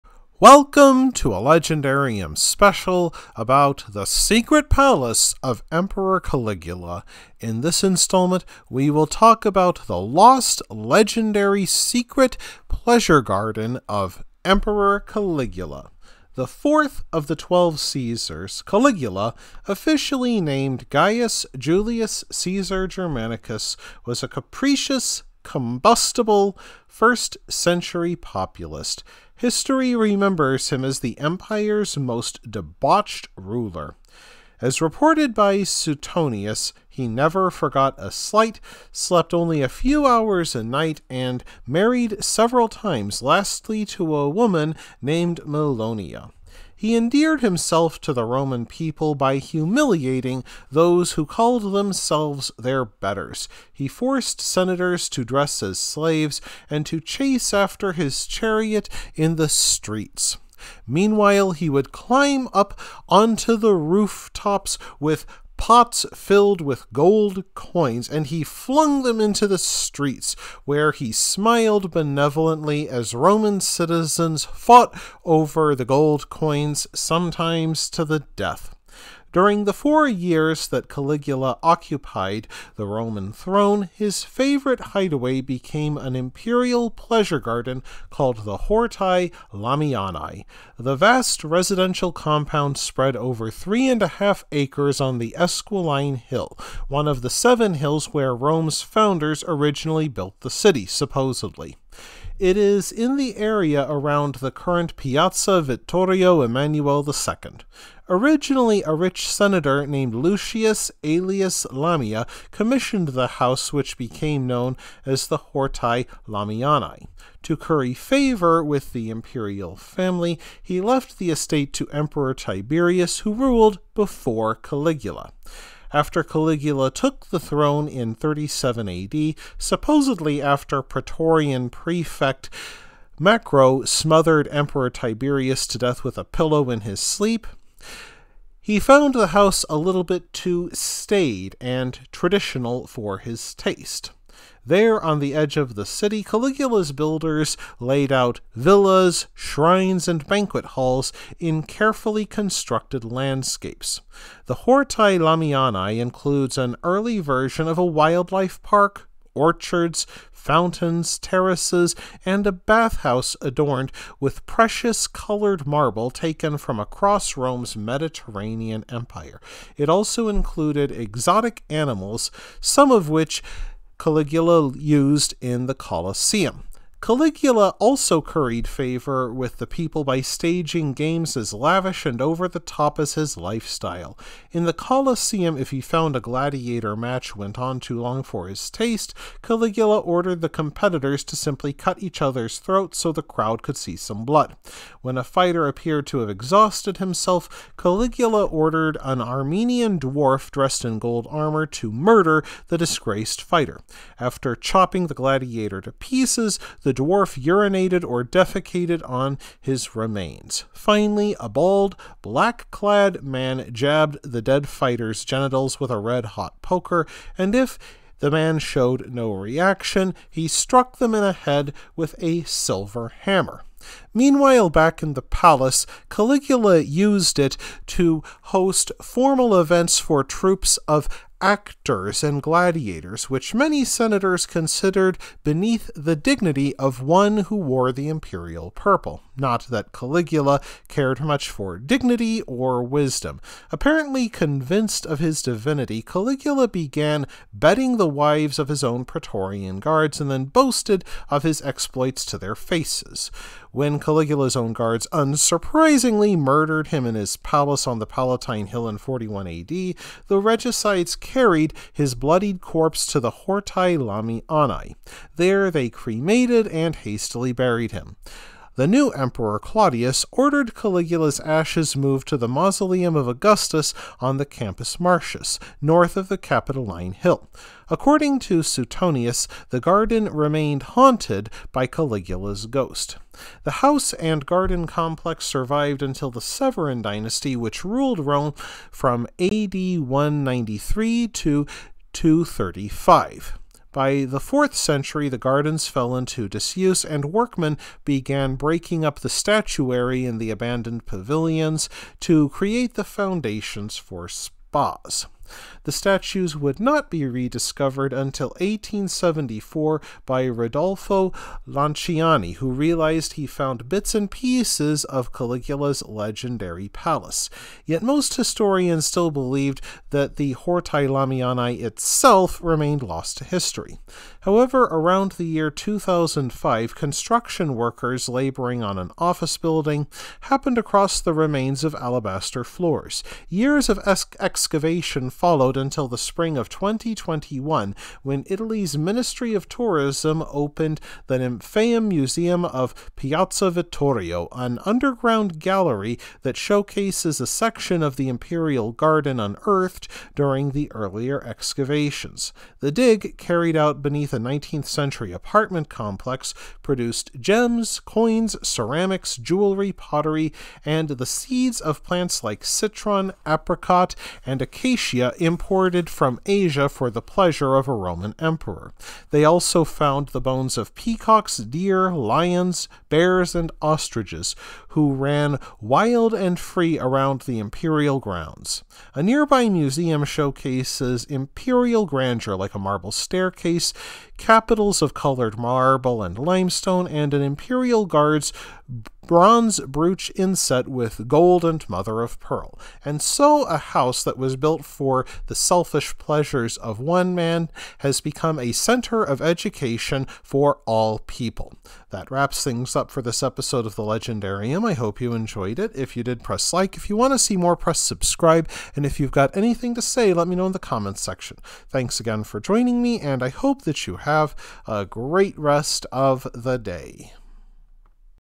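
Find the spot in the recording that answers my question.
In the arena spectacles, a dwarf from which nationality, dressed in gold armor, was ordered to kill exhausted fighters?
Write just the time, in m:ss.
3:19.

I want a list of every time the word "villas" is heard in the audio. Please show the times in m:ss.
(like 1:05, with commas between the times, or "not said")
2:28.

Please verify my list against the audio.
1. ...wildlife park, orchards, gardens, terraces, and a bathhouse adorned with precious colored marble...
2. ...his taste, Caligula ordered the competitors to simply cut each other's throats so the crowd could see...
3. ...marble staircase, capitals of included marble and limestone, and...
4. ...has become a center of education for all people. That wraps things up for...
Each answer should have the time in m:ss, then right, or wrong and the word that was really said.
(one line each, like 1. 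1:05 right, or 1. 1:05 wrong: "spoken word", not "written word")
1. 2:37 wrong: "fountains", not "gardens"
2. 3:08 right
3. 6:22 wrong: "colored", not "included"
4. 6:37 right.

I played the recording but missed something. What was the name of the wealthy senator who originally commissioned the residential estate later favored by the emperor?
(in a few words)
Lucius Aelius Lamia.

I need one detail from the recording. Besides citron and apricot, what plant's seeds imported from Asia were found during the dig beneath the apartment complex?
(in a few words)
acacia.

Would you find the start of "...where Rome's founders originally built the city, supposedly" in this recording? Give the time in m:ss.
1:38.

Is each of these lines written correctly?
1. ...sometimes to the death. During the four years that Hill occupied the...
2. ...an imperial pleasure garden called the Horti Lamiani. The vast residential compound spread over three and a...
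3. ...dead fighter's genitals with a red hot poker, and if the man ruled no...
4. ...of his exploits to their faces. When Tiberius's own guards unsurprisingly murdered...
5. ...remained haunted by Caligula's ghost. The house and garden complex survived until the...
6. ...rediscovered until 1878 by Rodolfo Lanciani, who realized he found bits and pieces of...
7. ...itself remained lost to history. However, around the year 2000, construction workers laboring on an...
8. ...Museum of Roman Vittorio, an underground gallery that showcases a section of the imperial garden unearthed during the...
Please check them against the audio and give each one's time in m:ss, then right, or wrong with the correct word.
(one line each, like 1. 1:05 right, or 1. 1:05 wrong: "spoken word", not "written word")
1. 1:16 wrong: "Caligula", not "Hill"
2. 1:25 right
3. 3:34 wrong: "showed", not "ruled"
4. 4:11 wrong: "Caligula", not "Tiberius"
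5. 4:40 right
6. 5:07 wrong: "1874", not "1878"
7. 5:21 wrong: "2005", not "2000"
8. 5:42 wrong: "Piazza", not "Roman".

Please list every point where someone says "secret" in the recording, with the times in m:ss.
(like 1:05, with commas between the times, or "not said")
0:04, 0:11.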